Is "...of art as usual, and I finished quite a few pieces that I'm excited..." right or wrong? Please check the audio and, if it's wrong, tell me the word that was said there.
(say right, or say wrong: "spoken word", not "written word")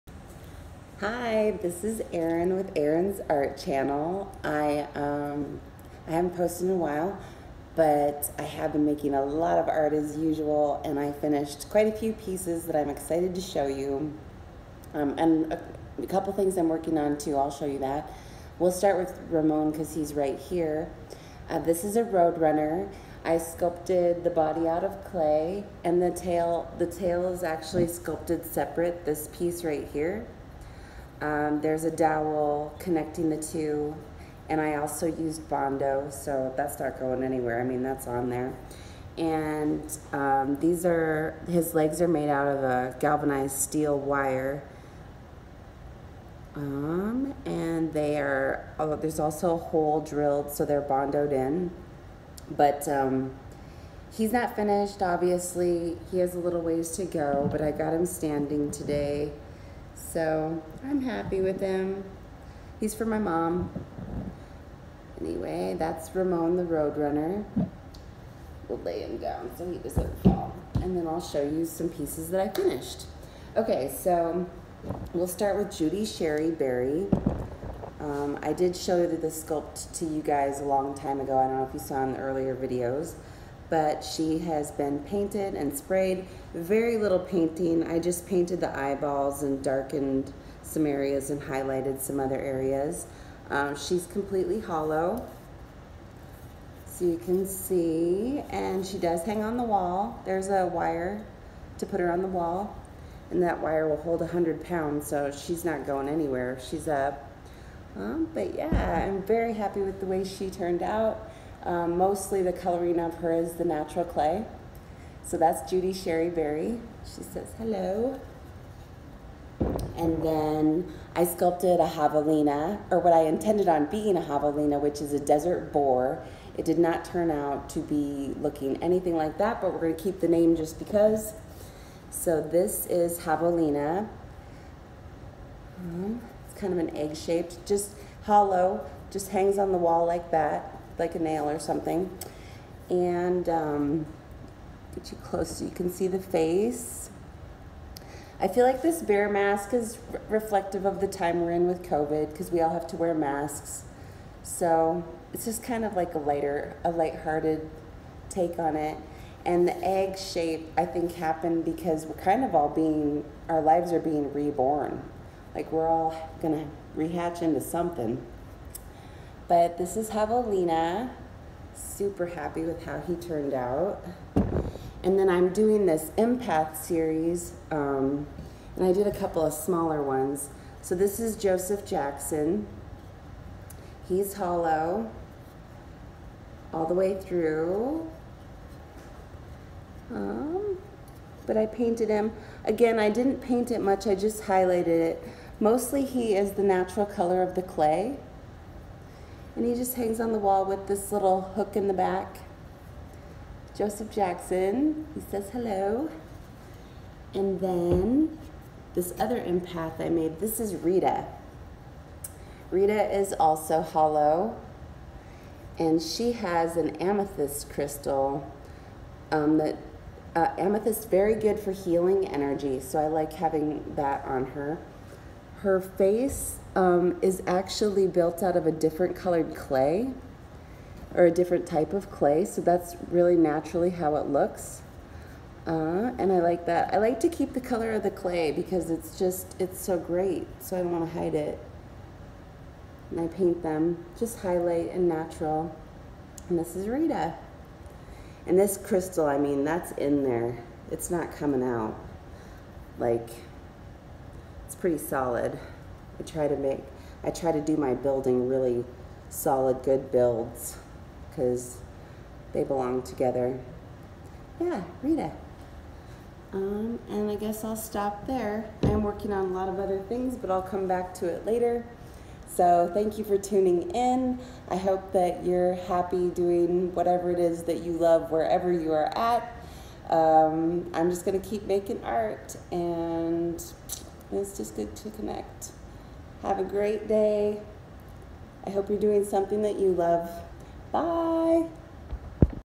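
right.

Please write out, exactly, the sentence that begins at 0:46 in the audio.
Um, and they are, oh, there's also a hole drilled, so they're bondoed in.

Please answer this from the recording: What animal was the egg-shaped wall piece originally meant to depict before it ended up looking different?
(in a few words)
desert boar.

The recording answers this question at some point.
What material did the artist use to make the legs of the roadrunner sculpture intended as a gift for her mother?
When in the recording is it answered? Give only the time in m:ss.
0:42.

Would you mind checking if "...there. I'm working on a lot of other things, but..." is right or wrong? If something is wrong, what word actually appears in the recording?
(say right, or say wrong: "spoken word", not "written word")
right.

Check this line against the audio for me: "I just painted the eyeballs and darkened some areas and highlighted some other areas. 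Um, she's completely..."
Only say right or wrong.
right.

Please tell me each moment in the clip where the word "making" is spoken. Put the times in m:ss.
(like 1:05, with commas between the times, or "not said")
0:08, 4:41.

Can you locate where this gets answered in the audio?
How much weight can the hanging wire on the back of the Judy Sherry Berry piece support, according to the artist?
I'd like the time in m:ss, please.
1:44.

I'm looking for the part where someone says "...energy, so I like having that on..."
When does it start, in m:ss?
3:42.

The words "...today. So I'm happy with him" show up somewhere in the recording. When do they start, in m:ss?
0:58.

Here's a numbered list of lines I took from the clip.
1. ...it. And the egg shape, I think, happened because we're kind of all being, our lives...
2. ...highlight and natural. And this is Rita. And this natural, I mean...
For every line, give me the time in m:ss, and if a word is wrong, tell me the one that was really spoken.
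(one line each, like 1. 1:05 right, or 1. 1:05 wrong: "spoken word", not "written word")
1. 2:38 right
2. 4:04 wrong: "crystal", not "natural".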